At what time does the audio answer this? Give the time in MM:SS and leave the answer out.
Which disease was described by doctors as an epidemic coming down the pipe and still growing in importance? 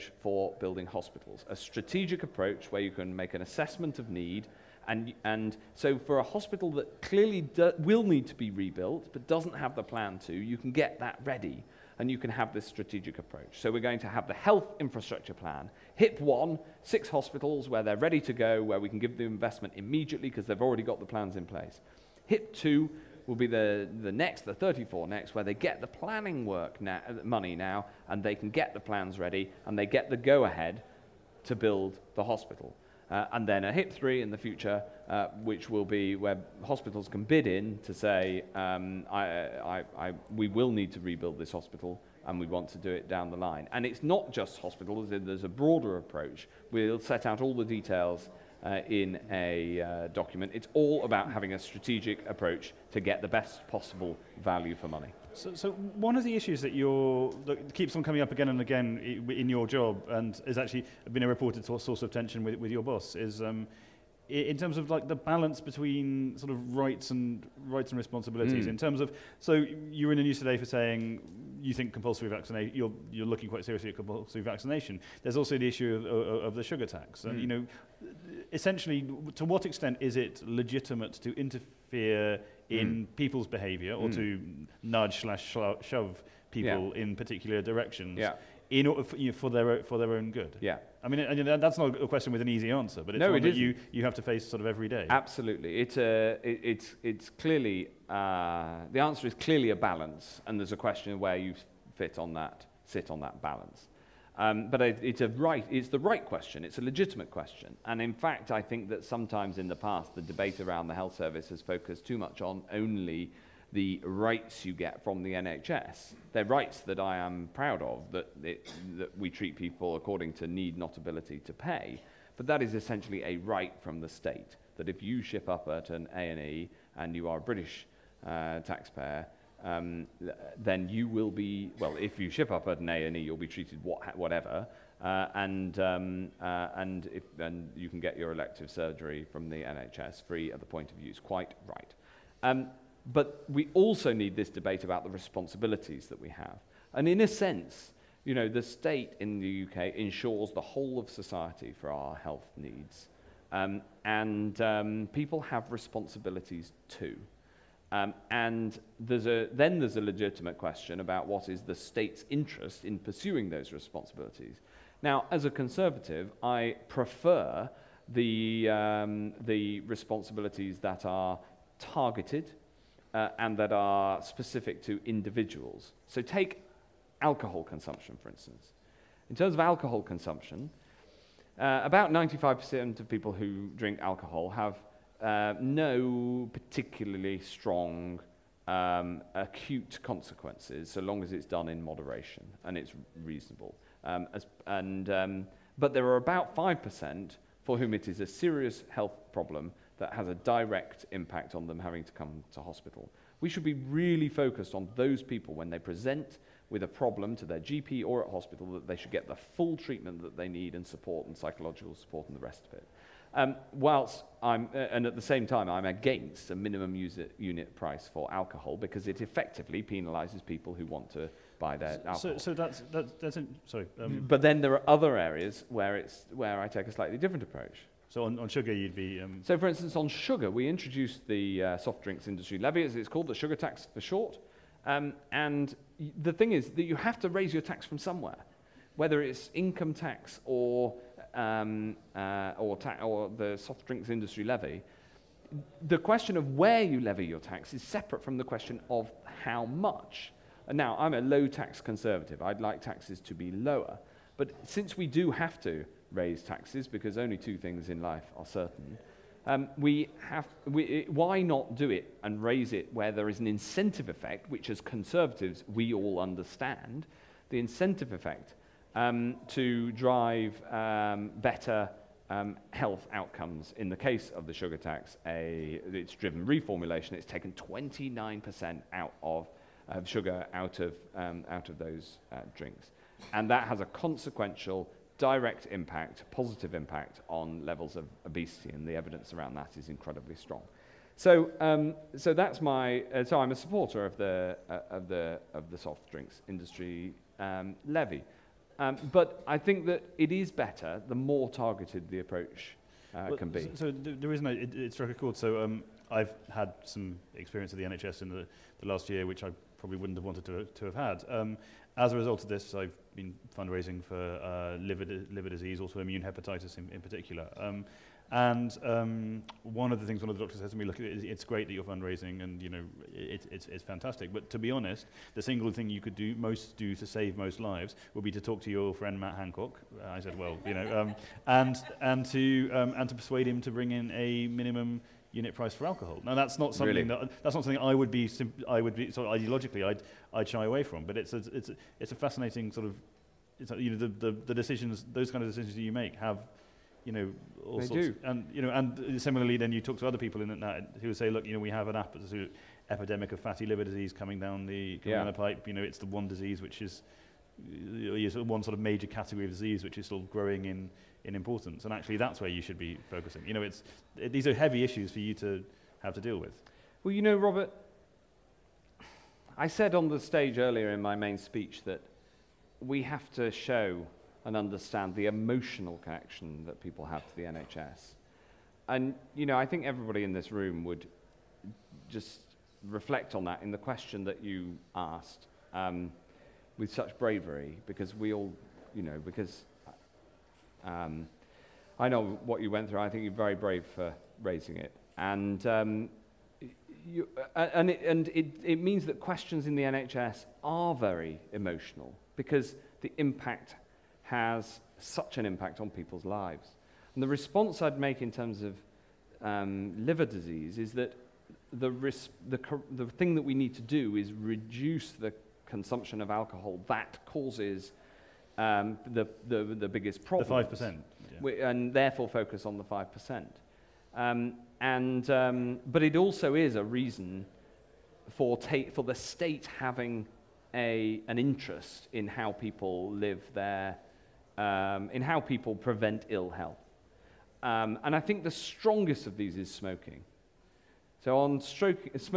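05:53.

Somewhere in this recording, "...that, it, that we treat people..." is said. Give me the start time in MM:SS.
01:58.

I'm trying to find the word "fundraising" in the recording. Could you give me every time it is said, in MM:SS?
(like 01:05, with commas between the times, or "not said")
05:13, 05:21.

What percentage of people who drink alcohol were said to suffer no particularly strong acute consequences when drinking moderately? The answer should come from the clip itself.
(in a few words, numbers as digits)
95%.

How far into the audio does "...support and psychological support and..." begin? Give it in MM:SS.
03:30.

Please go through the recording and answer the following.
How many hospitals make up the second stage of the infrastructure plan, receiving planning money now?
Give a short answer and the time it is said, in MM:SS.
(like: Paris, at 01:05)
34, at 00:24.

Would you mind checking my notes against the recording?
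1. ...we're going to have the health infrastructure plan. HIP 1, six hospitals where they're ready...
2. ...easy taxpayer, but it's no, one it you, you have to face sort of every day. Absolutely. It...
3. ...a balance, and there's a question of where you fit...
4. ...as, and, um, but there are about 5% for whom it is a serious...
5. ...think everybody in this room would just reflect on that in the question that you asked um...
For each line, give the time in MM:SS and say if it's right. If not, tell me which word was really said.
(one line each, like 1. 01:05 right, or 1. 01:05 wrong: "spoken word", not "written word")
1. 00:13 right
2. 01:32 wrong: "answer", not "taxpayer"
3. 01:39 right
4. 03:14 right
5. 06:19 right.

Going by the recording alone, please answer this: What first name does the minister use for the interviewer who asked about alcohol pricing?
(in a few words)
Robert.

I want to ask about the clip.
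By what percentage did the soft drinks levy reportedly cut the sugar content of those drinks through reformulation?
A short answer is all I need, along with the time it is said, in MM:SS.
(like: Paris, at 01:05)
29%, at 04:37.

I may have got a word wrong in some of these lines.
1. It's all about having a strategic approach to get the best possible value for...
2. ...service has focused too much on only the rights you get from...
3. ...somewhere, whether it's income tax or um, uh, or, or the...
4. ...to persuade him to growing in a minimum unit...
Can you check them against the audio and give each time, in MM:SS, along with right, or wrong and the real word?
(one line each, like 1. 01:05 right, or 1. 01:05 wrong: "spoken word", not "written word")
1. 00:50 right
2. 01:51 right
3. 03:57 right
4. 05:33 wrong: "bring", not "growing".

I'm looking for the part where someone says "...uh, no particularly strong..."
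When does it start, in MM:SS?
03:05.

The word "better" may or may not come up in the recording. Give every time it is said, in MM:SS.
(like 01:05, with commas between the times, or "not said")
04:31, 05:00.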